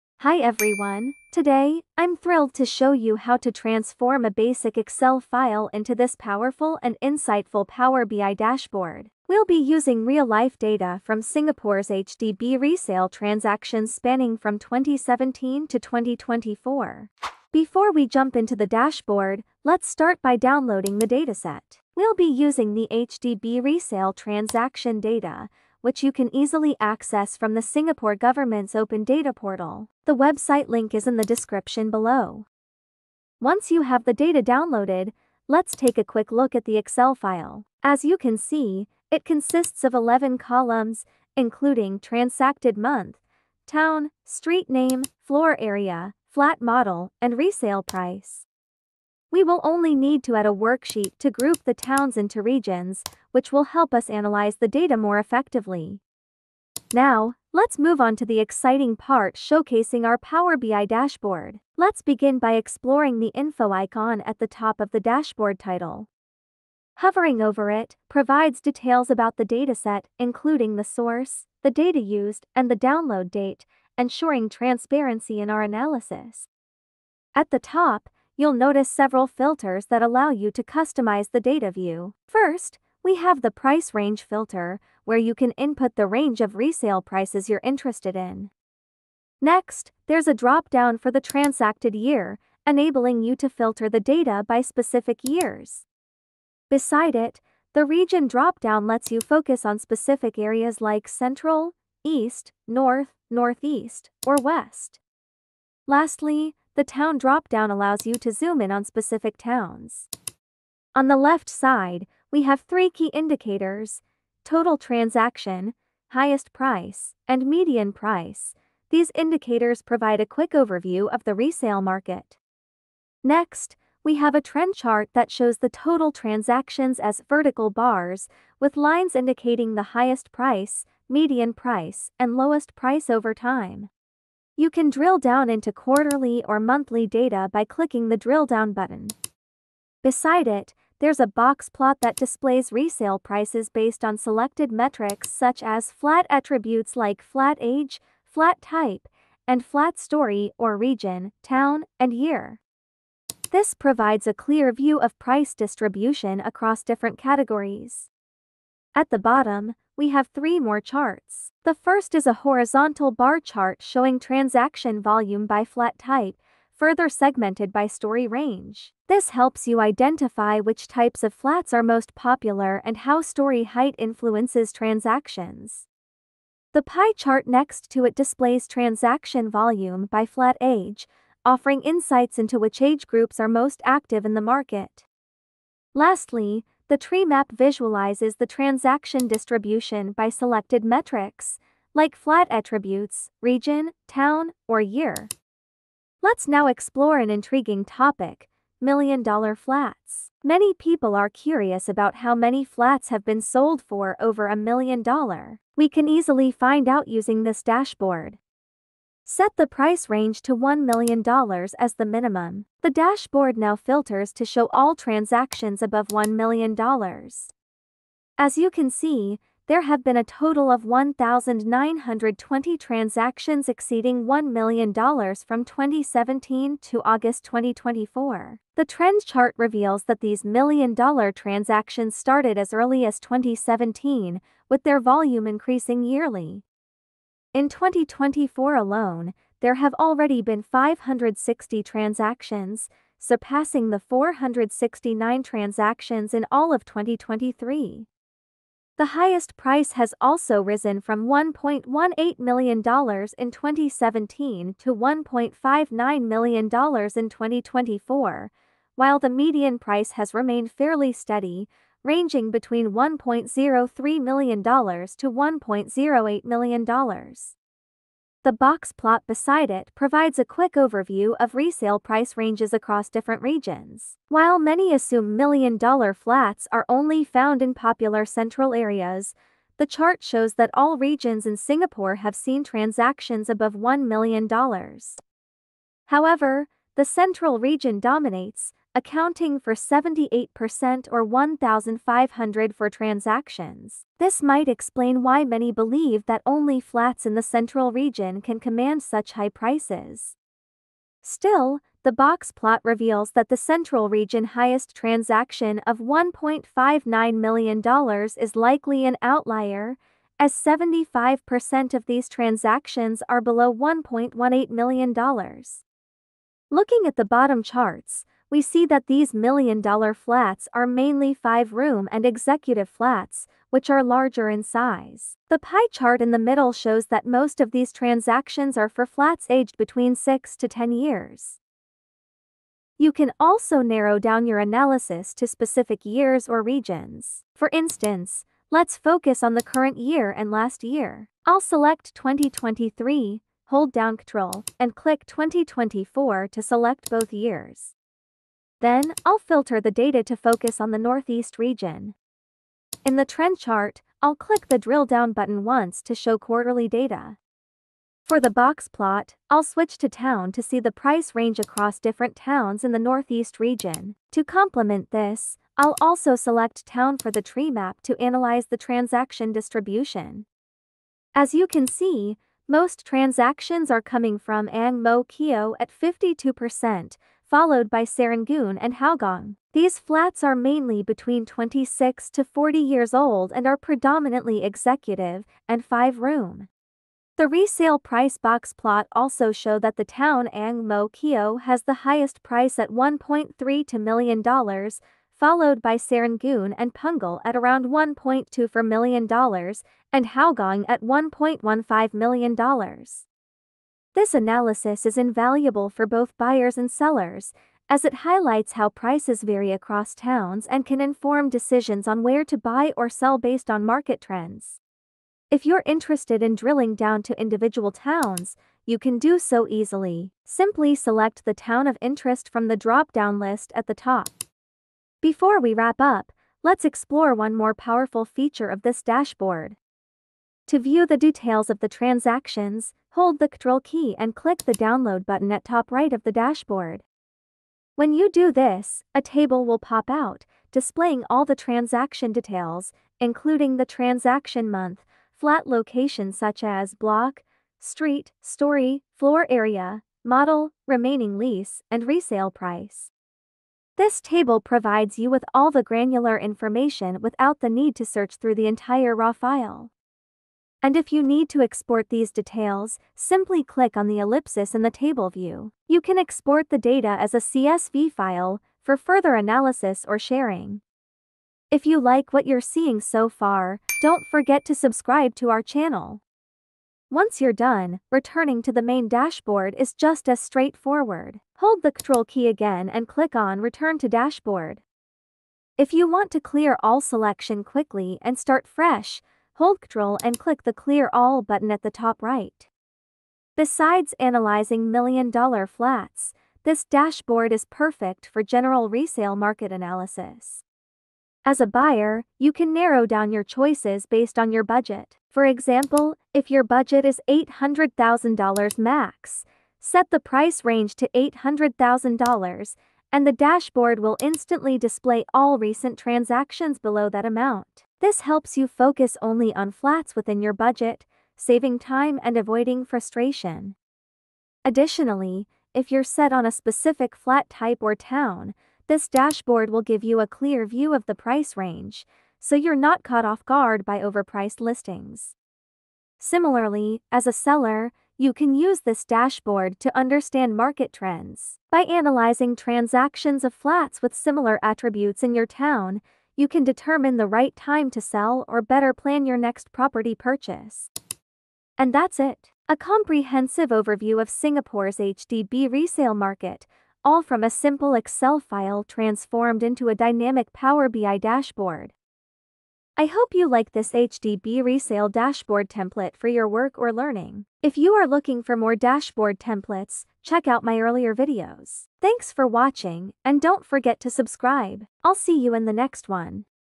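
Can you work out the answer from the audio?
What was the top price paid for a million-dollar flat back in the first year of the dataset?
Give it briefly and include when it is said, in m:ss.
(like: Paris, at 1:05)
$1.18 million, at 4:11.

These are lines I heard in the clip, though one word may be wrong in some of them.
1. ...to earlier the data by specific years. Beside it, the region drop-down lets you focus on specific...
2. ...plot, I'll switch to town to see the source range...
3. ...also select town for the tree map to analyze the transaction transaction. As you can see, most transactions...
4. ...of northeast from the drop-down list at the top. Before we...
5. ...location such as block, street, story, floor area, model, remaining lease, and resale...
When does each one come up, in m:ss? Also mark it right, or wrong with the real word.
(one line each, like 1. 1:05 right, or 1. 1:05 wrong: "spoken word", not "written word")
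1. 1:33 wrong: "filter", not "earlier"
2. 5:58 wrong: "price", not "source"
3. 6:06 wrong: "distribution", not "transaction"
4. 7:01 wrong: "interest", not "northeast"
5. 7:25 right.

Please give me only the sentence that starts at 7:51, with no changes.
If you like what you're seeing so far, don't forget to subscribe to our channel.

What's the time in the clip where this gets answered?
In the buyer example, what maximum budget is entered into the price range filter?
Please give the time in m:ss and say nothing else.
8:27.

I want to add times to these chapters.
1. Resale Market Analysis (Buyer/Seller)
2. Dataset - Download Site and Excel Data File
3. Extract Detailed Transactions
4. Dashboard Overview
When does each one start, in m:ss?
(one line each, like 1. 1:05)
1. 8:13
2. 0:17
3. 7:05
4. 0:57.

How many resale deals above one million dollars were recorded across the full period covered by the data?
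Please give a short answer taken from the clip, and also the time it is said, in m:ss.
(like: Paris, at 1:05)
1,920, at 3:40.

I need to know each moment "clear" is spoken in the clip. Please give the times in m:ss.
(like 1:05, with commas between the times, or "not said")
2:34, 8:06, 8:10, 8:50.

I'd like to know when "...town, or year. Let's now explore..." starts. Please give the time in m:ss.
3:14.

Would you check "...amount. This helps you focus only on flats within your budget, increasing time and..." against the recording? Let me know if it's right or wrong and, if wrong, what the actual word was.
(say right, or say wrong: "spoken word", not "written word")
wrong: "saving", not "increasing".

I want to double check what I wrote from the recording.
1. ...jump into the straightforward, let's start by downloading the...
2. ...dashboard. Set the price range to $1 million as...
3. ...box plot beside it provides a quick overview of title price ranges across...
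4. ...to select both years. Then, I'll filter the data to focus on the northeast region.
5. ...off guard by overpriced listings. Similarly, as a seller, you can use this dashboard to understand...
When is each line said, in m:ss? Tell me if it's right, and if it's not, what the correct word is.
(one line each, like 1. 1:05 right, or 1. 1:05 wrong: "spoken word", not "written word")
1. 0:18 wrong: "dashboard", not "straightforward"
2. 3:27 right
3. 4:28 wrong: "resale", not "title"
4. 5:46 right
5. 8:53 right.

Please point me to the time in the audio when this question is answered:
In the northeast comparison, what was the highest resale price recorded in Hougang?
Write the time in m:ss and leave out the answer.
6:41.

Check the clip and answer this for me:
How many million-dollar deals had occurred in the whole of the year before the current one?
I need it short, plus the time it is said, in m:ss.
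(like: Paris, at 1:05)
469, at 4:04.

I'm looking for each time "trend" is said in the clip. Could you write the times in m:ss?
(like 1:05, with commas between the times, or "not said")
2:04, 3:48, 5:53, 6:54, 9:00.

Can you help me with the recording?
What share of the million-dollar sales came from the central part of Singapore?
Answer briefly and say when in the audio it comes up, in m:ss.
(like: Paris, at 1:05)
78%, at 4:49.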